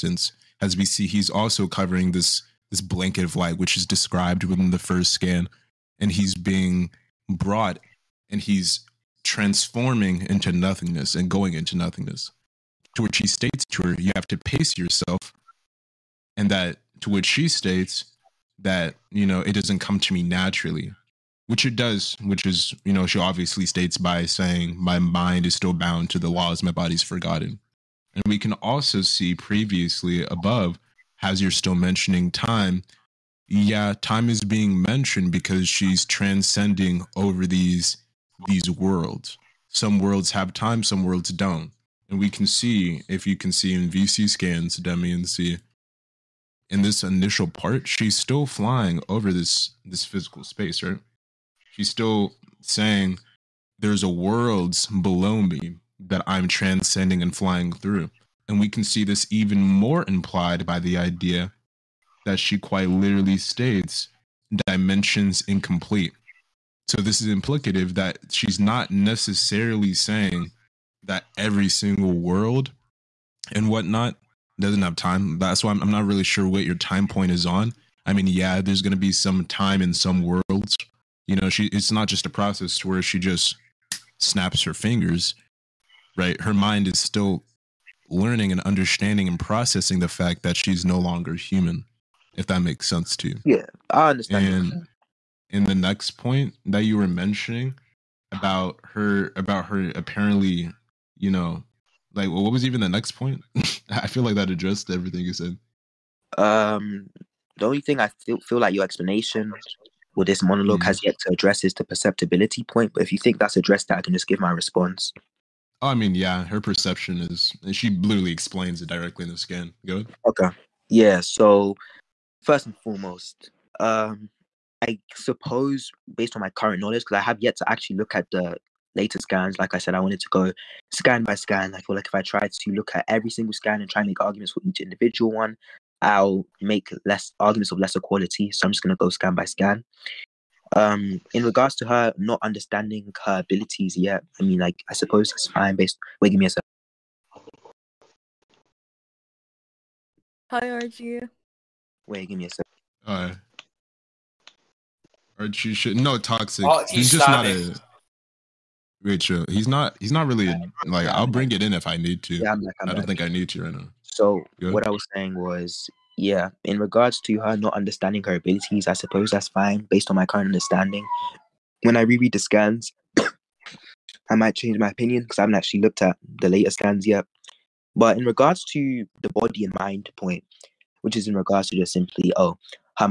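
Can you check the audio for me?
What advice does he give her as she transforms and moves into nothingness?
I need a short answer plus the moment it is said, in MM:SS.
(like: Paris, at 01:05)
Pace yourself, at 00:14.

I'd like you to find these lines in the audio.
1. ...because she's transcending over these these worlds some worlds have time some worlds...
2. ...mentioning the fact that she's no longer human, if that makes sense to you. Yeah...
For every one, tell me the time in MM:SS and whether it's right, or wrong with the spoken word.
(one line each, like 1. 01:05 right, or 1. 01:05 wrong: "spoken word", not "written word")
1. 00:35 right
2. 01:29 wrong: "processing", not "mentioning".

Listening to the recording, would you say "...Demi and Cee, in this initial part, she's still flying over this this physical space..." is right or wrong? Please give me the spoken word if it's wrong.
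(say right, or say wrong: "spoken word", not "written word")
right.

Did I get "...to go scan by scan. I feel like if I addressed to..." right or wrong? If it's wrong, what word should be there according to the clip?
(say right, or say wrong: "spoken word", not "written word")
wrong: "tried", not "addressed".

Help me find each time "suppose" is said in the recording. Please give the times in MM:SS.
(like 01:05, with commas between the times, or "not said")
02:05, 02:24, 02:48.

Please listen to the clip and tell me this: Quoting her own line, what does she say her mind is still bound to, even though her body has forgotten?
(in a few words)
The laws.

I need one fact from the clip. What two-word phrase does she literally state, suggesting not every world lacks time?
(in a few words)
Dimensions incomplete.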